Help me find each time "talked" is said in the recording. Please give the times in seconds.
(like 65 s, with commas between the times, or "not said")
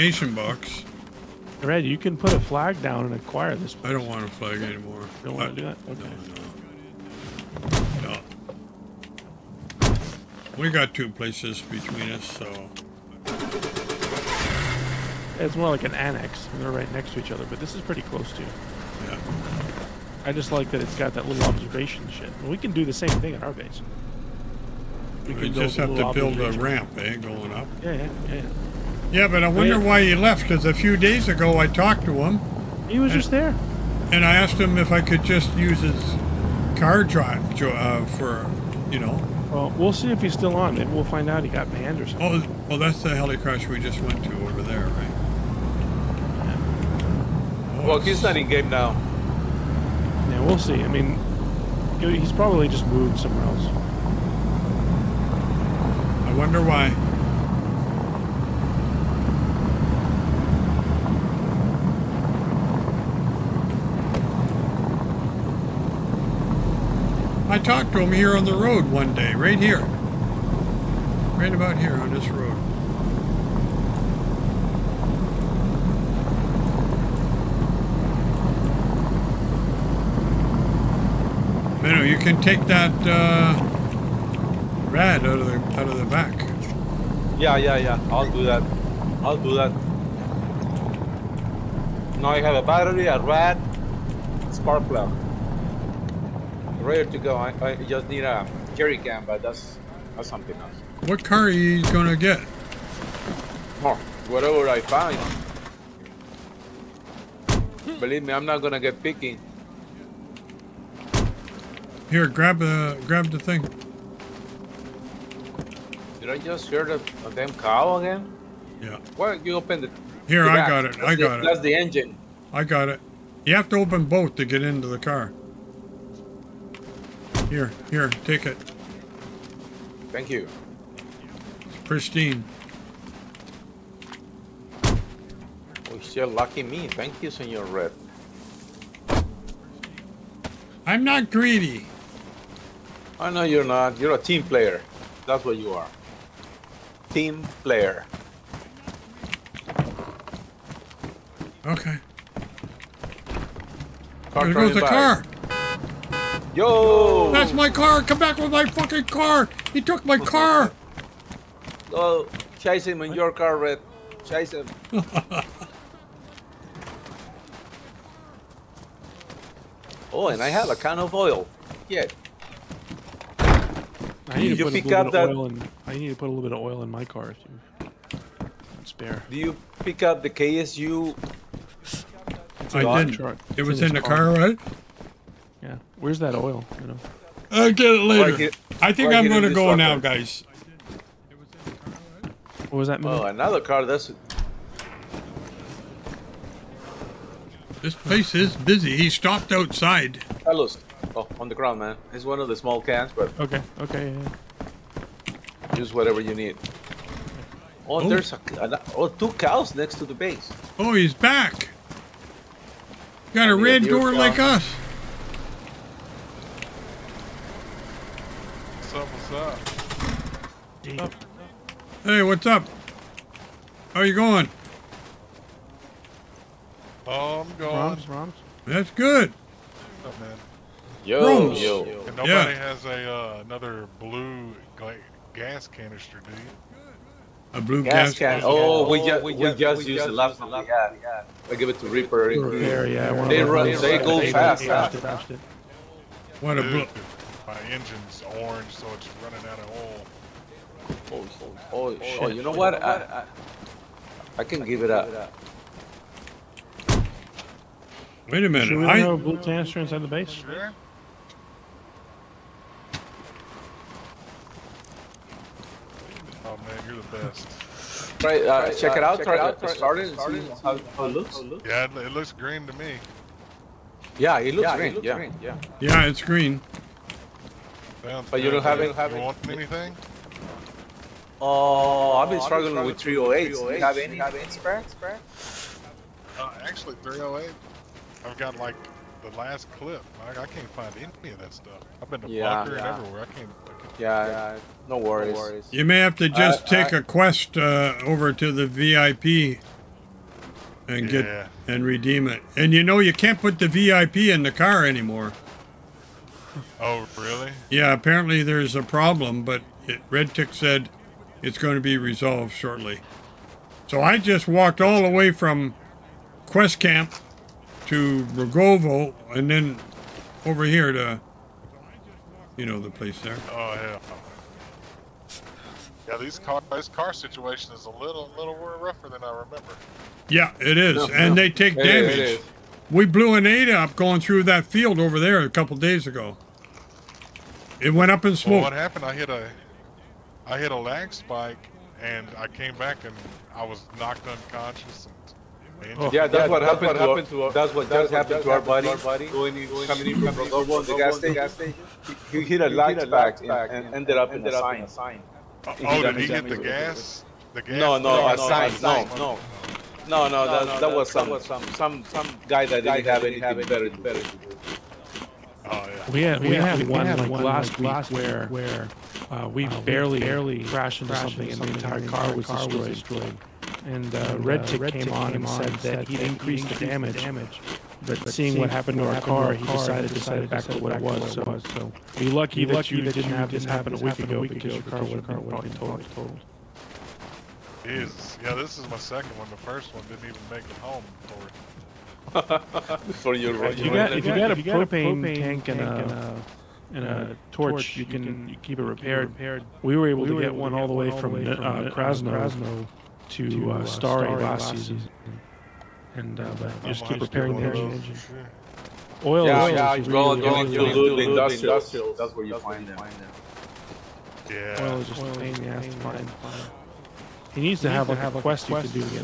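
31 s, 67 s.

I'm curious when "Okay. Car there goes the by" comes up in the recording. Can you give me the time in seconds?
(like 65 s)
151 s.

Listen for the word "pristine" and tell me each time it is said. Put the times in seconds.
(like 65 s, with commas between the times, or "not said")
131 s.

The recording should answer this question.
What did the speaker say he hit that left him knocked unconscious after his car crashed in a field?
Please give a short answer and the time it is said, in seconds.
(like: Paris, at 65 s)
a lag spike, at 340 s.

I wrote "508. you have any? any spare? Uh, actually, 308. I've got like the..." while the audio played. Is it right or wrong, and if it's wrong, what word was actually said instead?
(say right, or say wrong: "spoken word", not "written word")
wrong: "308", not "508".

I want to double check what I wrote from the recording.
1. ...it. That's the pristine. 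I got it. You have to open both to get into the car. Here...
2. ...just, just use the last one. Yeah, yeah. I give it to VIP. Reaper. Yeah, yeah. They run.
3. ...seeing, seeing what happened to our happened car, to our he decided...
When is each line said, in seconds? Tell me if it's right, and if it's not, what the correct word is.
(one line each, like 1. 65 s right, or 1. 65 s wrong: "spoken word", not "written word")
1. 121 s wrong: "engine", not "pristine"
2. 239 s wrong: "Reaper", not "VIP"
3. 378 s right.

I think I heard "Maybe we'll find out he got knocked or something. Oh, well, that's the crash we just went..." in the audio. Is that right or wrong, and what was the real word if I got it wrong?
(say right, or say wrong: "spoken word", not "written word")
wrong: "banned", not "knocked".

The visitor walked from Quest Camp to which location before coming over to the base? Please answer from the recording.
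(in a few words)
Rogovo.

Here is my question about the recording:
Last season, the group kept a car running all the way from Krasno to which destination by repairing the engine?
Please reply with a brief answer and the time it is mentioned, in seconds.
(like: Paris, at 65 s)
Stary, at 403 s.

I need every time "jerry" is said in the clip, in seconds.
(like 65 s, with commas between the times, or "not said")
98 s.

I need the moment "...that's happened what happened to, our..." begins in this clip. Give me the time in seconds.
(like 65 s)
346 s.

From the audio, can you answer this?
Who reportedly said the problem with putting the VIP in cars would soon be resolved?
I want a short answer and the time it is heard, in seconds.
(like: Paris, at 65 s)
Red-Tic, at 310 s.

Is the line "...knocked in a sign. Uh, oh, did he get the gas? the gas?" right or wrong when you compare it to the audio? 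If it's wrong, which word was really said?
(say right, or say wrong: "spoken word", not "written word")
wrong: "ended", not "knocked".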